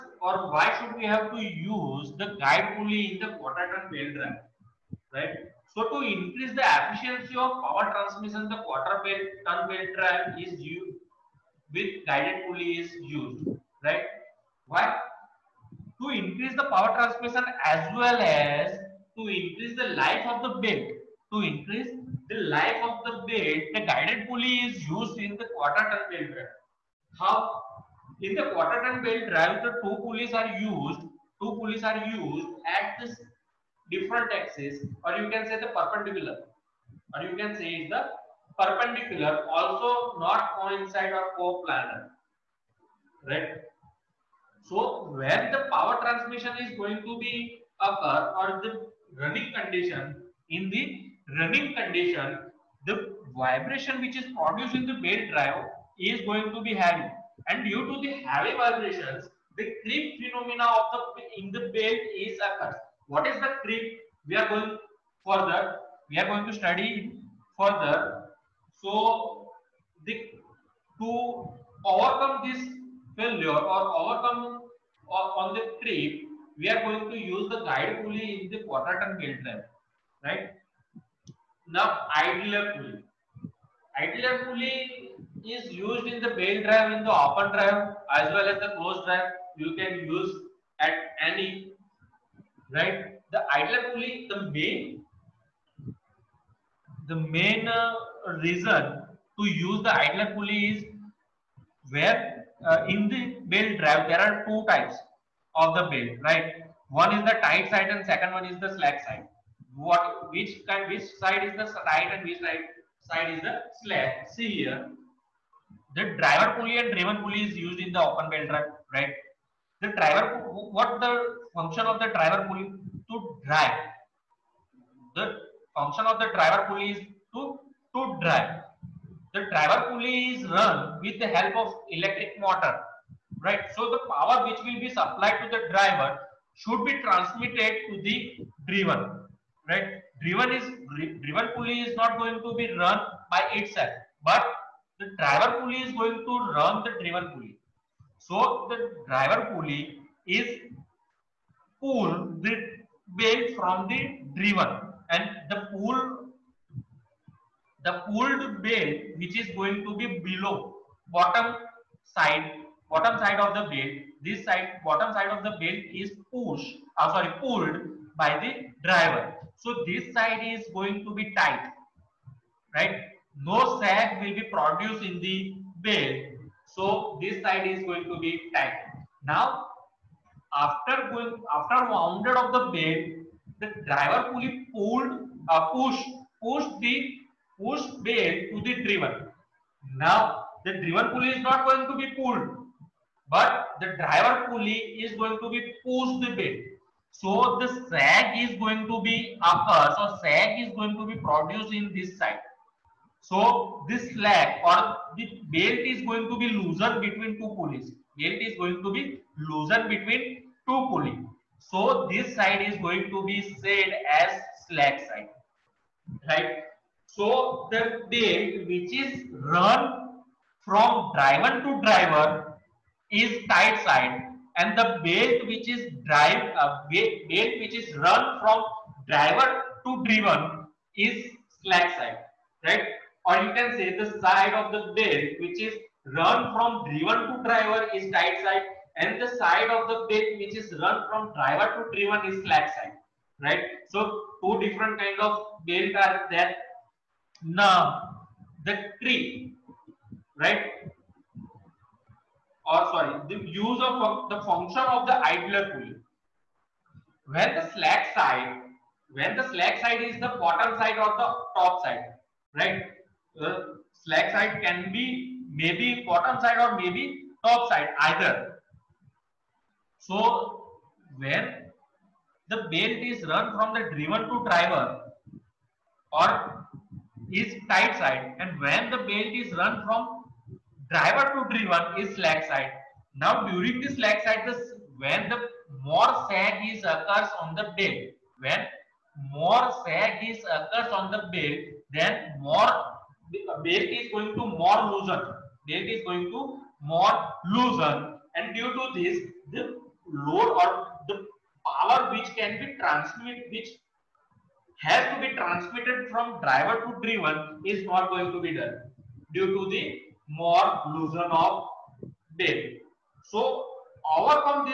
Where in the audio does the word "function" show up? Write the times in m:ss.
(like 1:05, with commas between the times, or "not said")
2:01, 2:05, 4:14.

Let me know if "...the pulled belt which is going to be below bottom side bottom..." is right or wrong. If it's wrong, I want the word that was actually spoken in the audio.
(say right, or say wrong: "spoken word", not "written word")
right.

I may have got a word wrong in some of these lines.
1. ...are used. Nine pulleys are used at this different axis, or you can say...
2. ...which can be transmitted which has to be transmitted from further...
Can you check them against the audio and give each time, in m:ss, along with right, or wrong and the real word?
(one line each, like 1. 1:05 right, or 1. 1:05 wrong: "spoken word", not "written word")
1. 0:30 wrong: "Two", not "Nine"
2. 5:02 wrong: "driver", not "further".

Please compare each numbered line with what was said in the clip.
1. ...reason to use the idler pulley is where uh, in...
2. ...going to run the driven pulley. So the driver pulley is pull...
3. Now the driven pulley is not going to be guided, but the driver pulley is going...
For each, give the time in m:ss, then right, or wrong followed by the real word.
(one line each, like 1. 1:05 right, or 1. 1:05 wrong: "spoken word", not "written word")
1. 1:38 right
2. 2:25 right
3. 3:09 wrong: "pulled", not "guided".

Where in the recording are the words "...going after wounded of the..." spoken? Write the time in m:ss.
3:01.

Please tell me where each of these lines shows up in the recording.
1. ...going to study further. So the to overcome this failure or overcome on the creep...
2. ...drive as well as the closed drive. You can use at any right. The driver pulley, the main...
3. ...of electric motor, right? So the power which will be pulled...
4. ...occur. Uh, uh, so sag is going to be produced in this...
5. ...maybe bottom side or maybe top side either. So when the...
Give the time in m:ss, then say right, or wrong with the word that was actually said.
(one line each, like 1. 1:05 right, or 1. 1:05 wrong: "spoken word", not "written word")
1. 1:06 right
2. 1:27 wrong: "idler", not "driver"
3. 2:11 wrong: "supplied", not "pulled"
4. 3:19 right
5. 4:25 right.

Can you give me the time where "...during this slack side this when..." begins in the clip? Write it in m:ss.
4:43.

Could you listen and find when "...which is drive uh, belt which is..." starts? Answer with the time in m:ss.
3:45.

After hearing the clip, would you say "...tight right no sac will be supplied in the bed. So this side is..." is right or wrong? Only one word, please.
wrong.